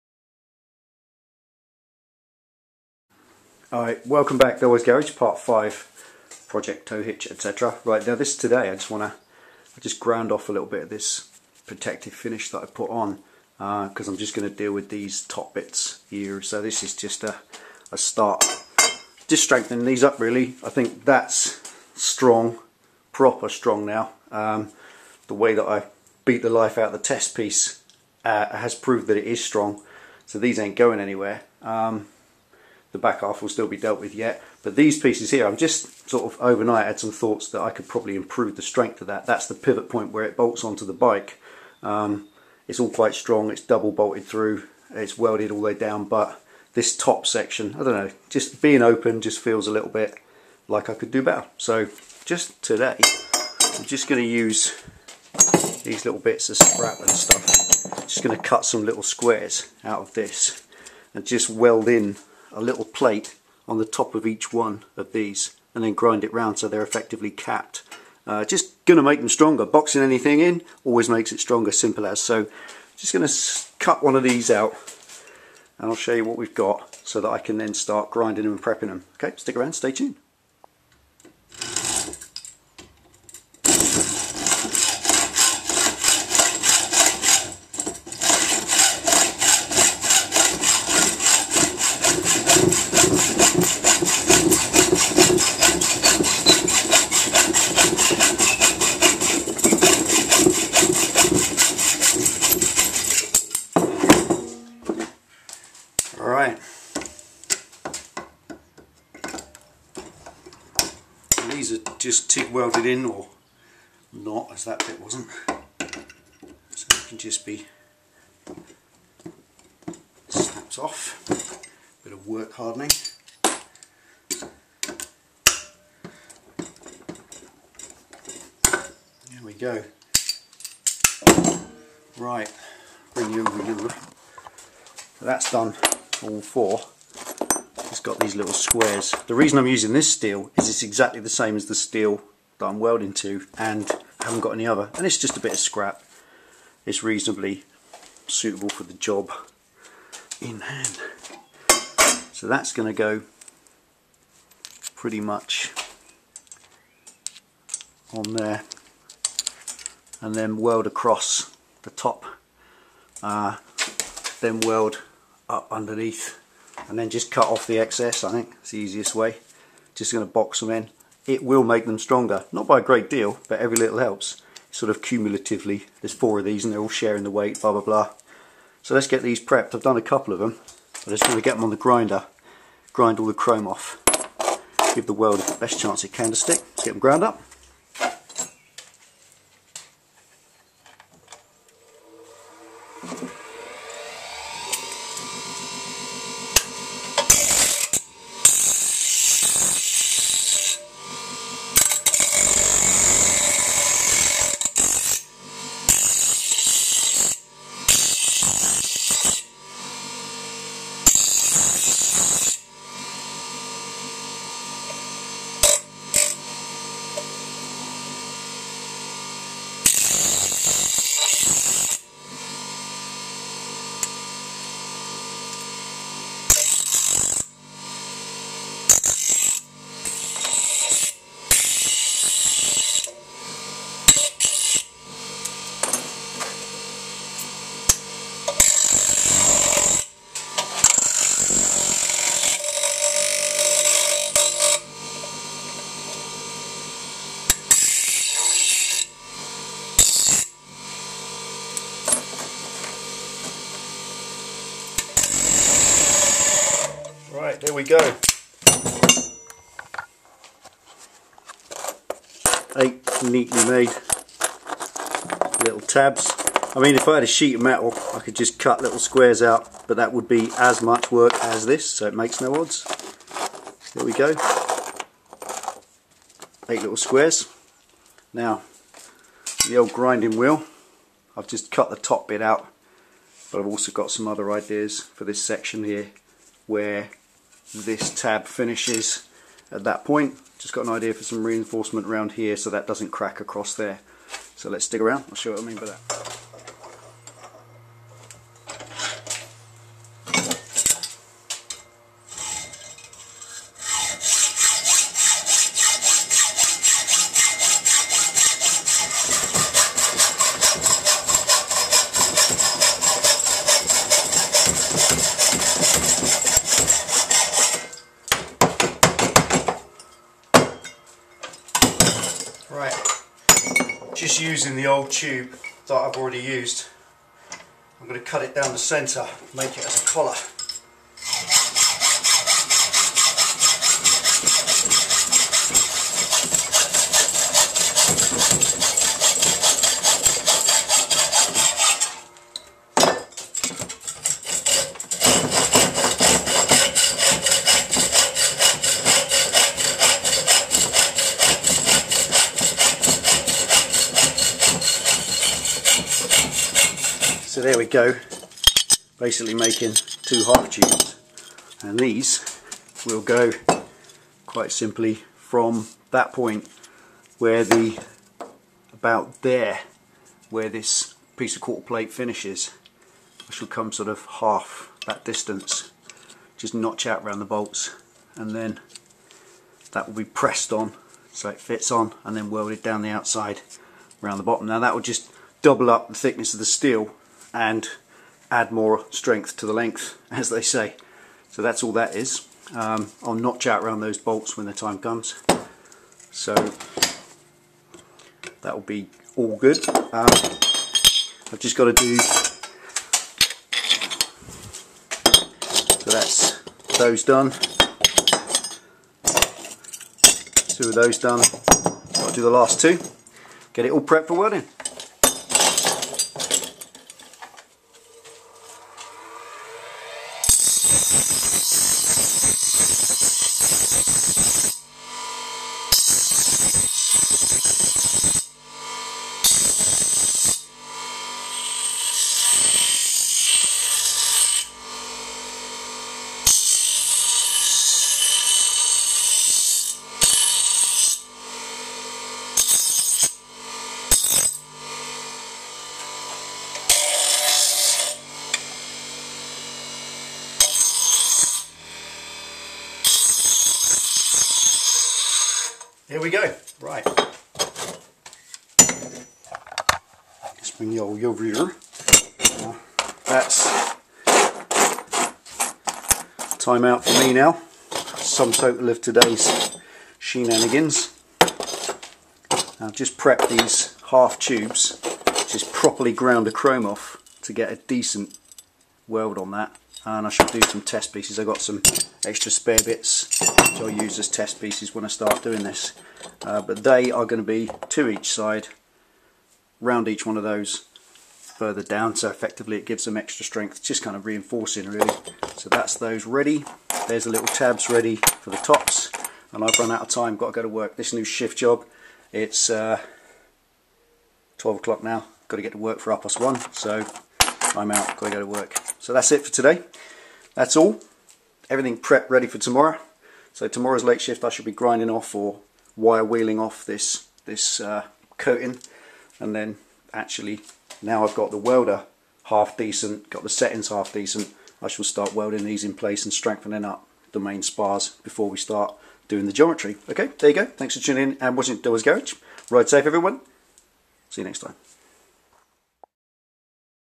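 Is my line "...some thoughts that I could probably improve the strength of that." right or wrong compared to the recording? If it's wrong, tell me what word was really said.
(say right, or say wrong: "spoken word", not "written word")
right.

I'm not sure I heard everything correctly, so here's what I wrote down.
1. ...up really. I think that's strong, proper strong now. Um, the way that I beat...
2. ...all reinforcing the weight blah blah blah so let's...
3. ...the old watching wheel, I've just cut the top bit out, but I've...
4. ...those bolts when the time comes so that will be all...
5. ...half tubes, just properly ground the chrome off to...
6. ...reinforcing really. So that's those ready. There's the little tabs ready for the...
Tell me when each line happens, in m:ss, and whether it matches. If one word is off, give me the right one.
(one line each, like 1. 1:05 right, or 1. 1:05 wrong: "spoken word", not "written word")
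1. 0:20 right
2. 2:56 wrong: "sharing", not "reinforcing"
3. 4:39 wrong: "grinding", not "watching"
4. 6:33 right
5. 7:54 right
6. 8:14 right.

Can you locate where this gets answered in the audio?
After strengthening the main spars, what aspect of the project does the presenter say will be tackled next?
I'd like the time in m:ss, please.
8:49.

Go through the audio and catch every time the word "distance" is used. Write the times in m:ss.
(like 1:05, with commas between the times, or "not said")
6:15.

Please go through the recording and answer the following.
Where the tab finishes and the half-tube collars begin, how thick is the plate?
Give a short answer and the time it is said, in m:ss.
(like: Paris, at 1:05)
Quarter plate, at 6:11.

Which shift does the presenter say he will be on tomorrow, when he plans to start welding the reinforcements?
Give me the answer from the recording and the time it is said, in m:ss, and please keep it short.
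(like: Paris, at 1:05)
Late shift, at 8:34.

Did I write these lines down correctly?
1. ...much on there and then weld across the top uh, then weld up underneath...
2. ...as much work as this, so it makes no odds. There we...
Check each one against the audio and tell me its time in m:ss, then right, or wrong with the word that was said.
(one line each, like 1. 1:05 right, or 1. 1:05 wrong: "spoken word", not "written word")
1. 2:35 right
2. 4:30 right.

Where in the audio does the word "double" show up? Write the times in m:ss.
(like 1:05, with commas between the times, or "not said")
0:43, 6:25.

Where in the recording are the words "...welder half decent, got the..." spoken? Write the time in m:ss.
8:41.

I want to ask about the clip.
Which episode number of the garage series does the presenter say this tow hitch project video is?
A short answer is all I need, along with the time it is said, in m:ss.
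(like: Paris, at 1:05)
Part 5, at 0:05.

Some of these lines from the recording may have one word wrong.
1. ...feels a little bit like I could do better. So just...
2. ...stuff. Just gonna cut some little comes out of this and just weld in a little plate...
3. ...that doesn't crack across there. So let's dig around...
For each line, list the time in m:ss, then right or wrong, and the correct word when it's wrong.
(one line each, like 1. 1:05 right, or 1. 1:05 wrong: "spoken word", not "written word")
1. 0:49 right
2. 0:57 wrong: "squares", not "comes"
3. 4:52 right.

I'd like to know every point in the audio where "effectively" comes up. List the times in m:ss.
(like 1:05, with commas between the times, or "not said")
1:06, 8:12.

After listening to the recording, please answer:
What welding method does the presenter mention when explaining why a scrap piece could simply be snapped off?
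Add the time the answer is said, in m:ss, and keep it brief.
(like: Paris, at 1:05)
TIG, at 1:52.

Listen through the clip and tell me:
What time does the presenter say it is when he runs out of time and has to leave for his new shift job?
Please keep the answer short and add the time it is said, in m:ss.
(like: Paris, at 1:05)
12 o'clock, at 8:24.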